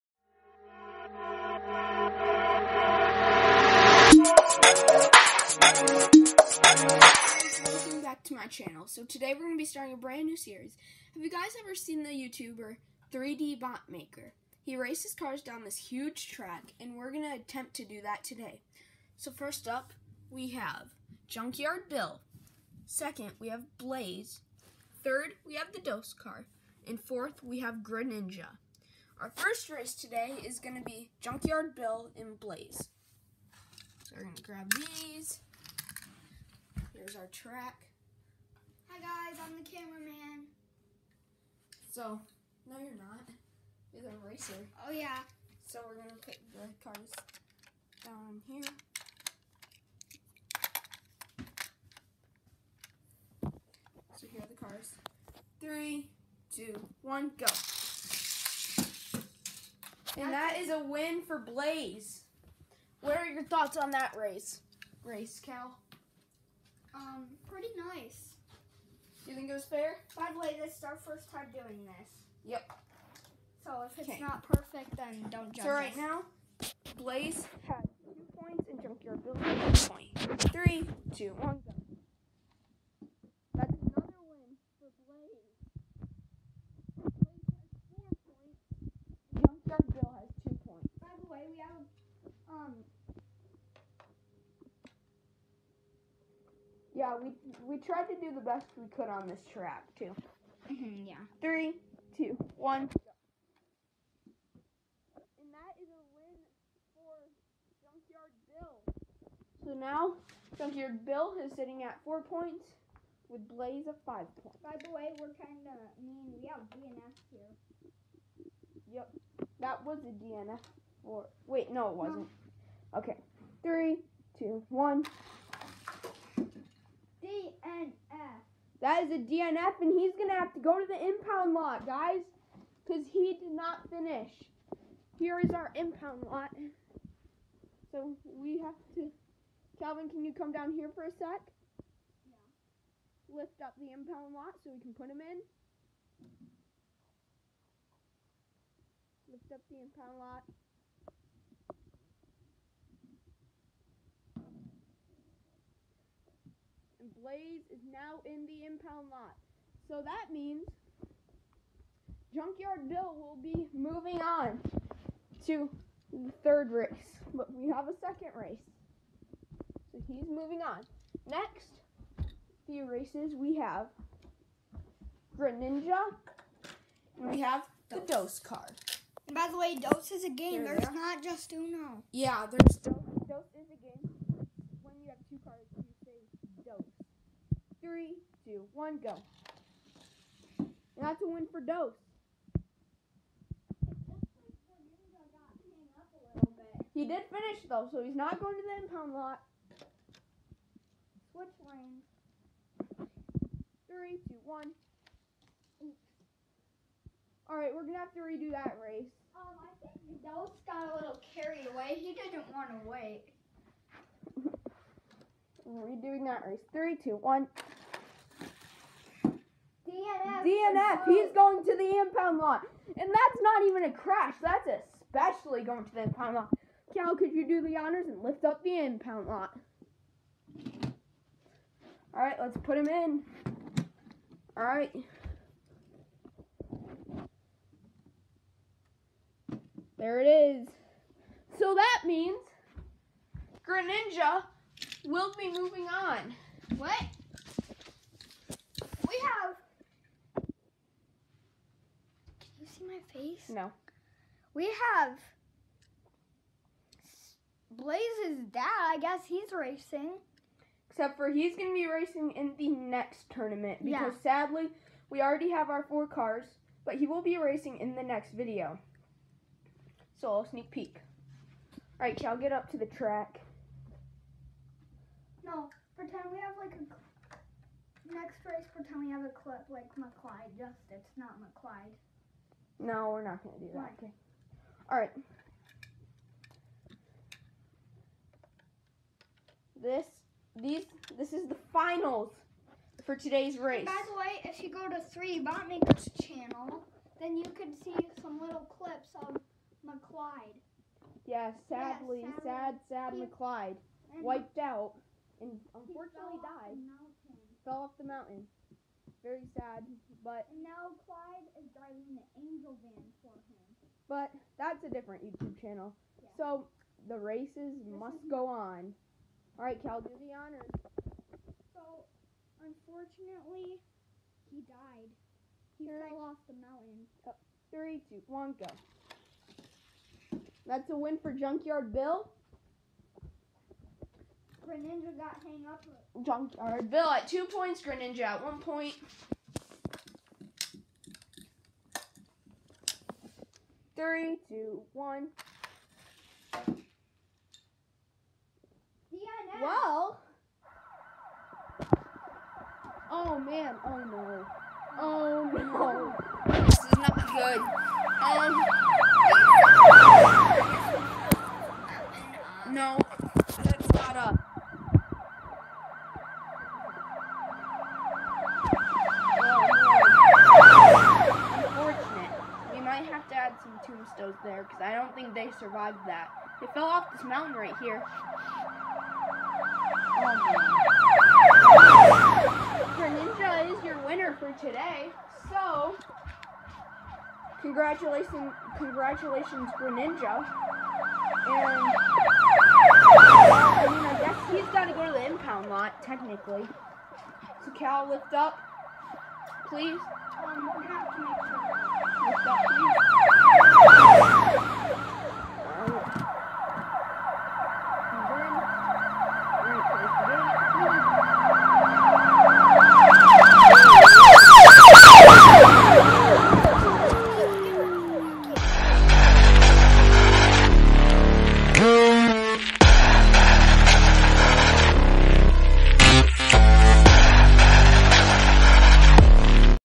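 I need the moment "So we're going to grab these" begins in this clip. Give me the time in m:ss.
0:34.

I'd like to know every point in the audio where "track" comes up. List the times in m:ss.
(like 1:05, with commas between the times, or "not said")
0:16, 0:37, 1:39, 4:32.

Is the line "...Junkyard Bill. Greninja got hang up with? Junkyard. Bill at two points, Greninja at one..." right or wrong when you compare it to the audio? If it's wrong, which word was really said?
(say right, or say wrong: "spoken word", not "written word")
right.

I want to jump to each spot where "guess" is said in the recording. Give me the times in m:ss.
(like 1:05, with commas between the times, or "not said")
4:19, 6:34.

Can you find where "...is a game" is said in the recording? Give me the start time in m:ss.
3:00.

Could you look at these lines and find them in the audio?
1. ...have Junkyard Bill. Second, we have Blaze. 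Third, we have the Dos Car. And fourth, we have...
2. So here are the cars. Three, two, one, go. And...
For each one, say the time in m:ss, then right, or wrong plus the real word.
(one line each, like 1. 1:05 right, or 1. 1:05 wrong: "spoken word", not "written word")
1. 0:20 right
2. 0:54 right.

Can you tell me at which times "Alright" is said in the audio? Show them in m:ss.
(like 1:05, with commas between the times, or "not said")
3:27, 4:31.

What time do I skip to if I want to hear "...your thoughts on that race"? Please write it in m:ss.
1:03.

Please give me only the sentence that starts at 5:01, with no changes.
Yeah, sadly, yeah, sadly sad, sad he, McClyde.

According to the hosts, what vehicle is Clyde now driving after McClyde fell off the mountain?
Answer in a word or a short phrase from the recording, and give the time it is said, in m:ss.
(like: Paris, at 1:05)
The angel van, at 5:12.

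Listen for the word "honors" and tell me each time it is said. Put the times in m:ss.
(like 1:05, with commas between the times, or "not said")
3:47, 5:20.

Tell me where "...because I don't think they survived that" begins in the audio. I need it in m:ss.
6:14.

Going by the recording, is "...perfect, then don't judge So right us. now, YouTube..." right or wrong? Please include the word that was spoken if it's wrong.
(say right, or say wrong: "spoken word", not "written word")
wrong: "Blaze", not "YouTube".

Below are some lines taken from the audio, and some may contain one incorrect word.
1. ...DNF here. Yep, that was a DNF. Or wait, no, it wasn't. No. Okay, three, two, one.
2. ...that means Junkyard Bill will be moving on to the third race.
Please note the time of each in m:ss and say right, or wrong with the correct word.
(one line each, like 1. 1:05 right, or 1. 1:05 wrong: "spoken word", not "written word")
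1. 1:56 right
2. 2:40 right.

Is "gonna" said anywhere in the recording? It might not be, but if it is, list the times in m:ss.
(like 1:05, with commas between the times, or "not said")
0:45, 3:27.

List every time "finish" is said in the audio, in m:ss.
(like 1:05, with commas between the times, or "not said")
2:13, 3:17.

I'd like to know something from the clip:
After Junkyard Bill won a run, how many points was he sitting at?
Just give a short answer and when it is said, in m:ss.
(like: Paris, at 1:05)
4, at 1:52.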